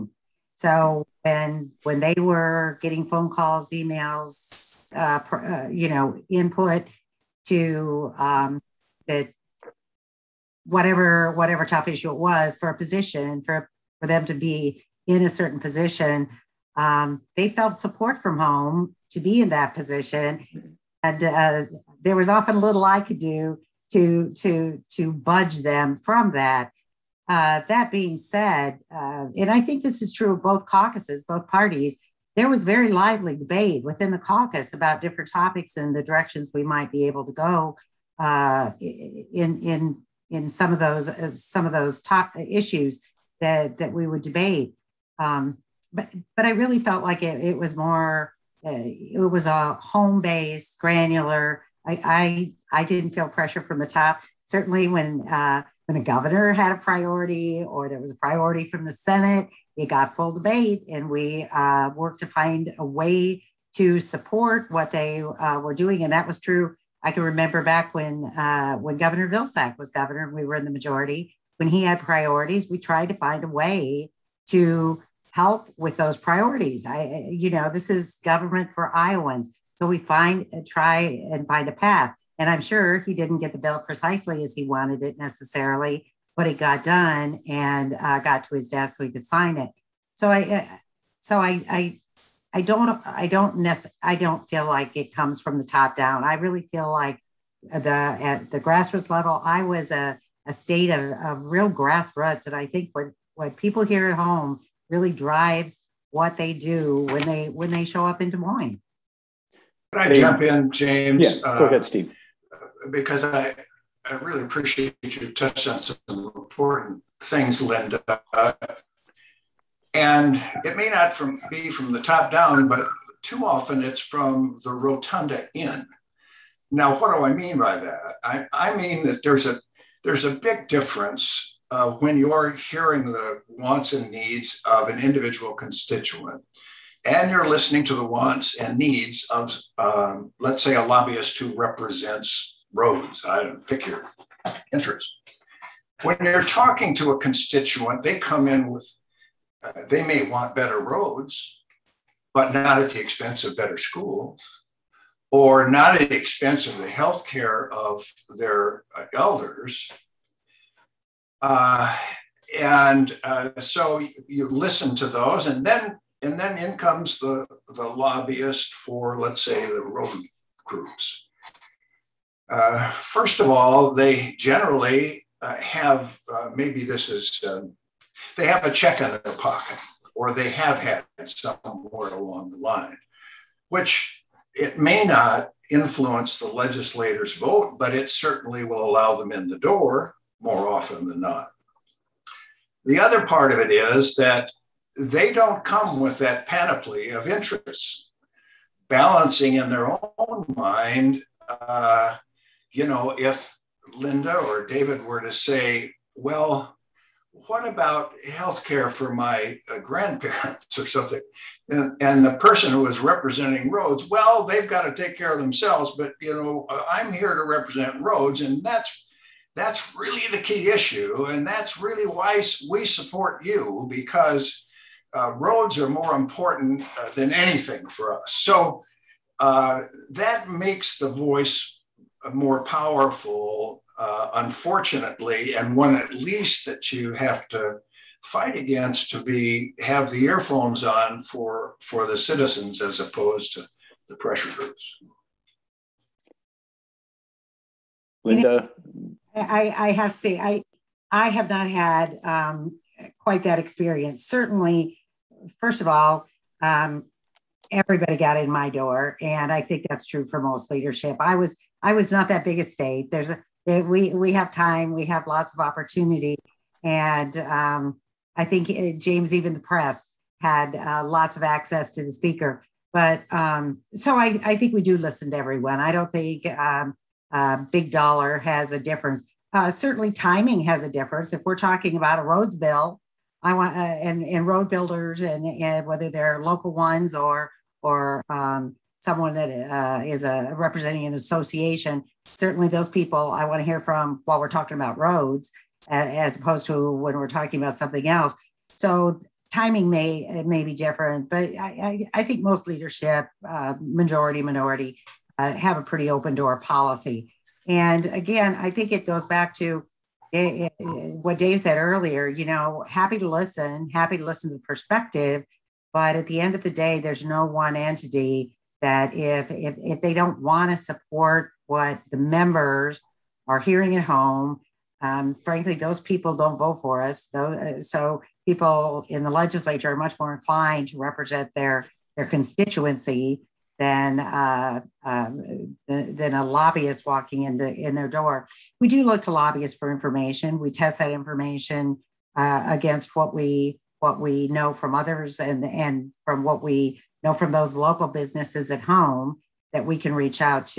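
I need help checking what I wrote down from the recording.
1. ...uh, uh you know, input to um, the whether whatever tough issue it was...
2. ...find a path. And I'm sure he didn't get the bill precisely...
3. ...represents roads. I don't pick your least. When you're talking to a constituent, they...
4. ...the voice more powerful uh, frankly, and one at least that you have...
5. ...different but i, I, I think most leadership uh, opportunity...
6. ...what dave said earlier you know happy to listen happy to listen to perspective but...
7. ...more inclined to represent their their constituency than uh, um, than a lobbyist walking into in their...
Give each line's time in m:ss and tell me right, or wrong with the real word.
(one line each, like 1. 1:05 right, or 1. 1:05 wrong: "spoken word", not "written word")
1. 0:04 wrong: "whatever", not "whether"
2. 1:21 right
3. 2:21 wrong: "interest", not "least"
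4. 3:50 wrong: "unfortunately", not "frankly"
5. 5:00 wrong: "majority", not "opportunity"
6. 5:11 right
7. 5:30 right.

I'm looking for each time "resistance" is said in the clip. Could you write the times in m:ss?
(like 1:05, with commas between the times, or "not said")
not said.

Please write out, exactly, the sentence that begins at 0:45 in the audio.
Um, but but I really felt like it, it was more uh, it was a home based granular.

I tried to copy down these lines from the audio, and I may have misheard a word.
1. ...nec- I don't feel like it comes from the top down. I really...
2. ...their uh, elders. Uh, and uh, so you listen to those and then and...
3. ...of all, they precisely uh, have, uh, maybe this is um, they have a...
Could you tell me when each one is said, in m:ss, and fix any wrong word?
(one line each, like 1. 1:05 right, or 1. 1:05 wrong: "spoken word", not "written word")
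1. 1:33 right
2. 2:38 right
3. 2:53 wrong: "generally", not "precisely".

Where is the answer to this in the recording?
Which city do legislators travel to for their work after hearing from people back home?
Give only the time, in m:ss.
1:48.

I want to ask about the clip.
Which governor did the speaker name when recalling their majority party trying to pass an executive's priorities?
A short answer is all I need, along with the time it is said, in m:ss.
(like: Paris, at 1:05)
Vilsack, at 1:08.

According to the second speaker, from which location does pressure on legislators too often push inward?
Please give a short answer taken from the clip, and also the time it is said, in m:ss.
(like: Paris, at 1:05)
the rotunda, at 2:04.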